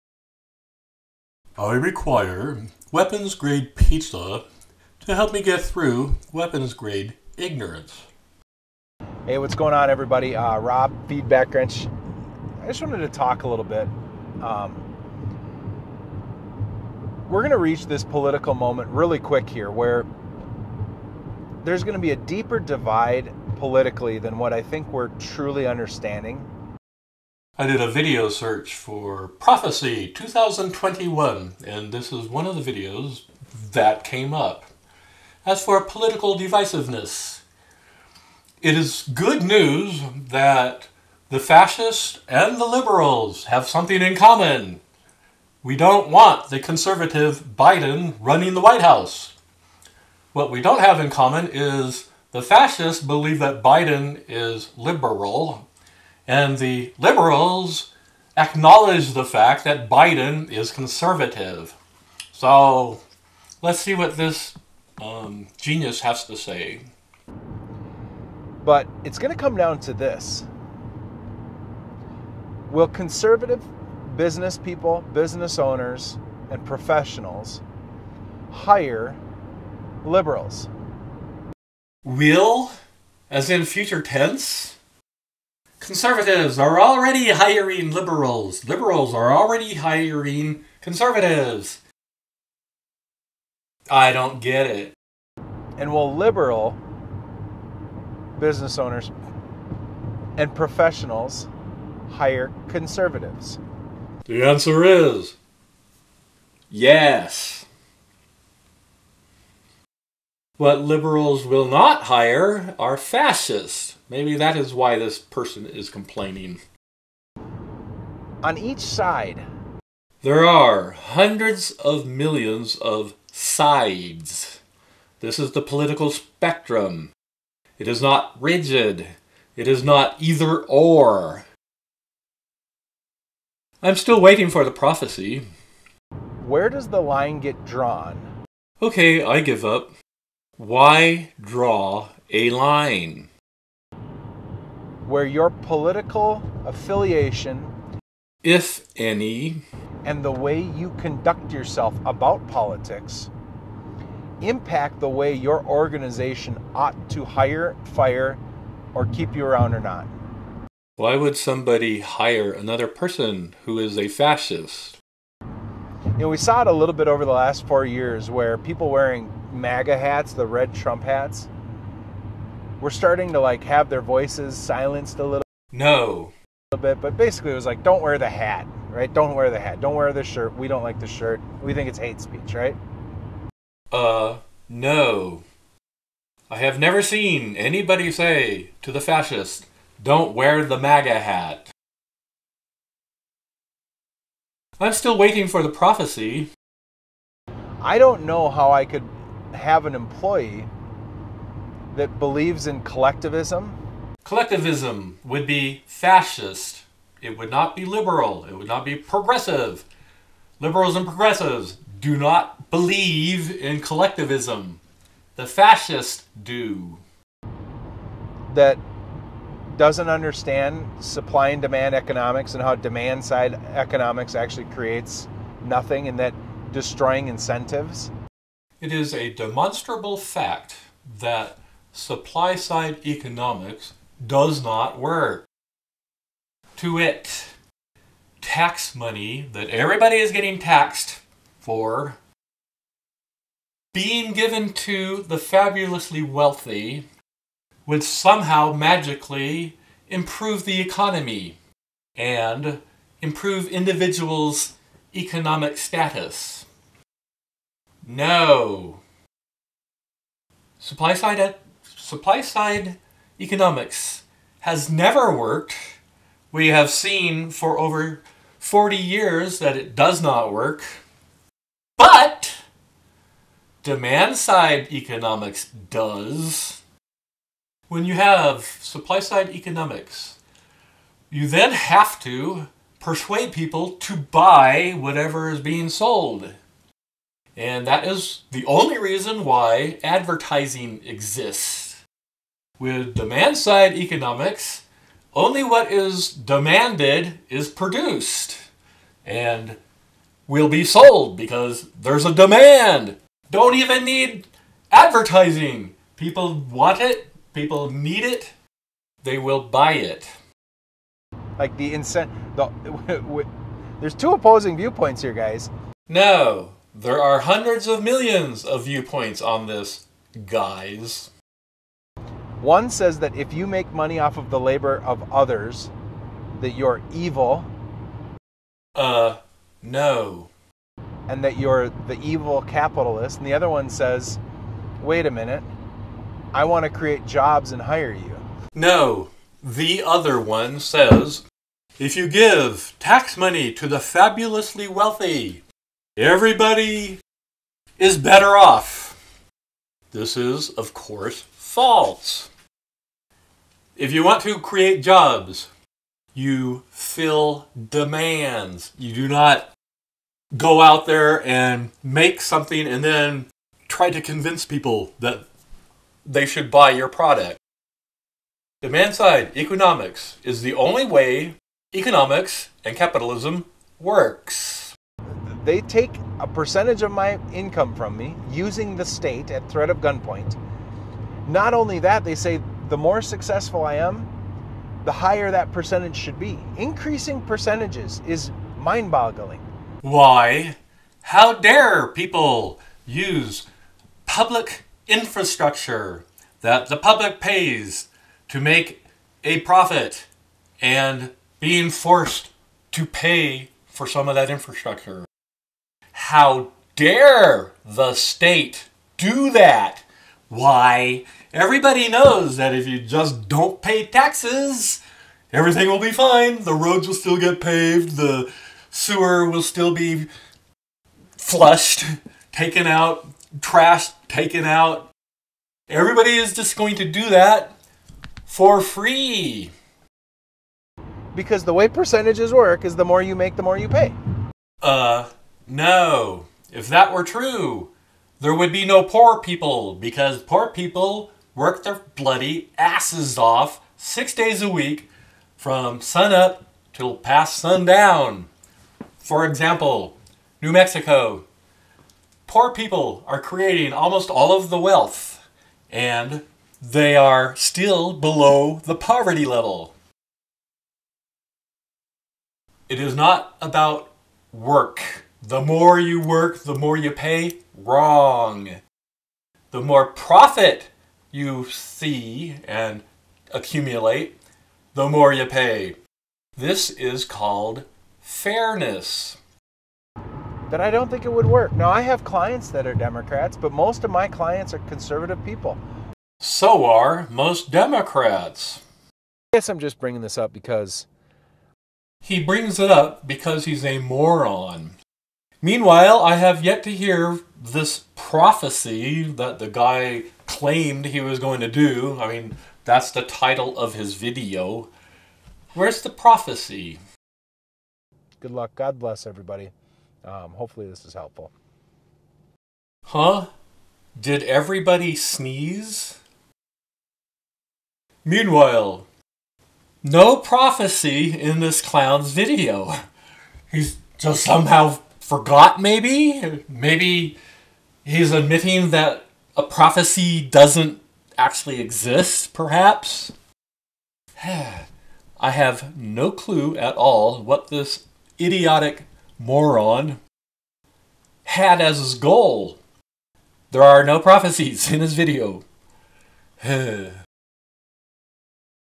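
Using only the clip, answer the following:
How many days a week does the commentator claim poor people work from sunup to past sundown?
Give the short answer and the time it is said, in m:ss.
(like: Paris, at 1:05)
6, at 7:23.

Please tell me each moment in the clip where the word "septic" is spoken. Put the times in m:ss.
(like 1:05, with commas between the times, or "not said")
not said.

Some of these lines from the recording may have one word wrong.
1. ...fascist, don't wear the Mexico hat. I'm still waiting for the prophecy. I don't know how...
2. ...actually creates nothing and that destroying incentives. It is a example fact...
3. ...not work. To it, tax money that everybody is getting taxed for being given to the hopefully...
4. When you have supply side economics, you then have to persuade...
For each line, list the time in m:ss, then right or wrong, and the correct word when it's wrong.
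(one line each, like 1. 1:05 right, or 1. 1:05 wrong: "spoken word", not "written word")
1. 3:08 wrong: "MAGA", not "Mexico"
2. 3:44 wrong: "demonstrable", not "example"
3. 3:54 wrong: "fabulously", not "hopefully"
4. 4:37 right.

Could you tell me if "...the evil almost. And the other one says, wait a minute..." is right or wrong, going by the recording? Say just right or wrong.
wrong.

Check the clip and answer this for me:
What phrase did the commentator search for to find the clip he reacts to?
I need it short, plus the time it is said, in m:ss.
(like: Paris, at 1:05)
Prophecy 2021, at 0:29.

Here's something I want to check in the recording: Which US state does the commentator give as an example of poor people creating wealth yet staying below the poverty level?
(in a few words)
New Mexico.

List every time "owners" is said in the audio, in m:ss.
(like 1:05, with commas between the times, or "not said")
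1:15, 1:38.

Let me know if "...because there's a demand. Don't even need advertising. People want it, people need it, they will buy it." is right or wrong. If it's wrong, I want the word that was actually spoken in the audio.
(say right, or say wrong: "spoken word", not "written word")
right.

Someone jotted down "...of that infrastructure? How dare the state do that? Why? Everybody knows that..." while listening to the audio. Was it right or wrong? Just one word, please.
right.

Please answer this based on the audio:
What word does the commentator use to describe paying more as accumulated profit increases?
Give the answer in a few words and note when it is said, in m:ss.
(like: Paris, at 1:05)
fairness, at 7:58.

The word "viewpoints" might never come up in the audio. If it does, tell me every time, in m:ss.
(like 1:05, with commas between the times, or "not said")
5:14, 5:18.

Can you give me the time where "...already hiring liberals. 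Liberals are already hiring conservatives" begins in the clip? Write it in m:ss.
1:26.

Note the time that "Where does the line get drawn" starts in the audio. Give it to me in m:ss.
2:16.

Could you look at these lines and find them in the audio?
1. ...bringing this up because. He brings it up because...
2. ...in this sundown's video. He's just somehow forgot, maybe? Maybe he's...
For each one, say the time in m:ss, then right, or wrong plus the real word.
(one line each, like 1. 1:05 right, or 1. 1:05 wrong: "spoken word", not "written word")
1. 8:09 right
2. 8:41 wrong: "clown", not "sundown".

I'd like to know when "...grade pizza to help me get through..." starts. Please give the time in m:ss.
0:03.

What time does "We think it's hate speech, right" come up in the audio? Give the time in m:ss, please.
3:01.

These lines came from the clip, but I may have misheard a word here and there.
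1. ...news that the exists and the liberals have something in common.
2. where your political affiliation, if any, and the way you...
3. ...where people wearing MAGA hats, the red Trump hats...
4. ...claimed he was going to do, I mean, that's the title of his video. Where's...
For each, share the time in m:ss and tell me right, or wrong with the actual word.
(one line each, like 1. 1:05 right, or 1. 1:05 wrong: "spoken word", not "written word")
1. 0:39 wrong: "fascists", not "exists"
2. 2:25 right
3. 2:48 right
4. 8:20 right.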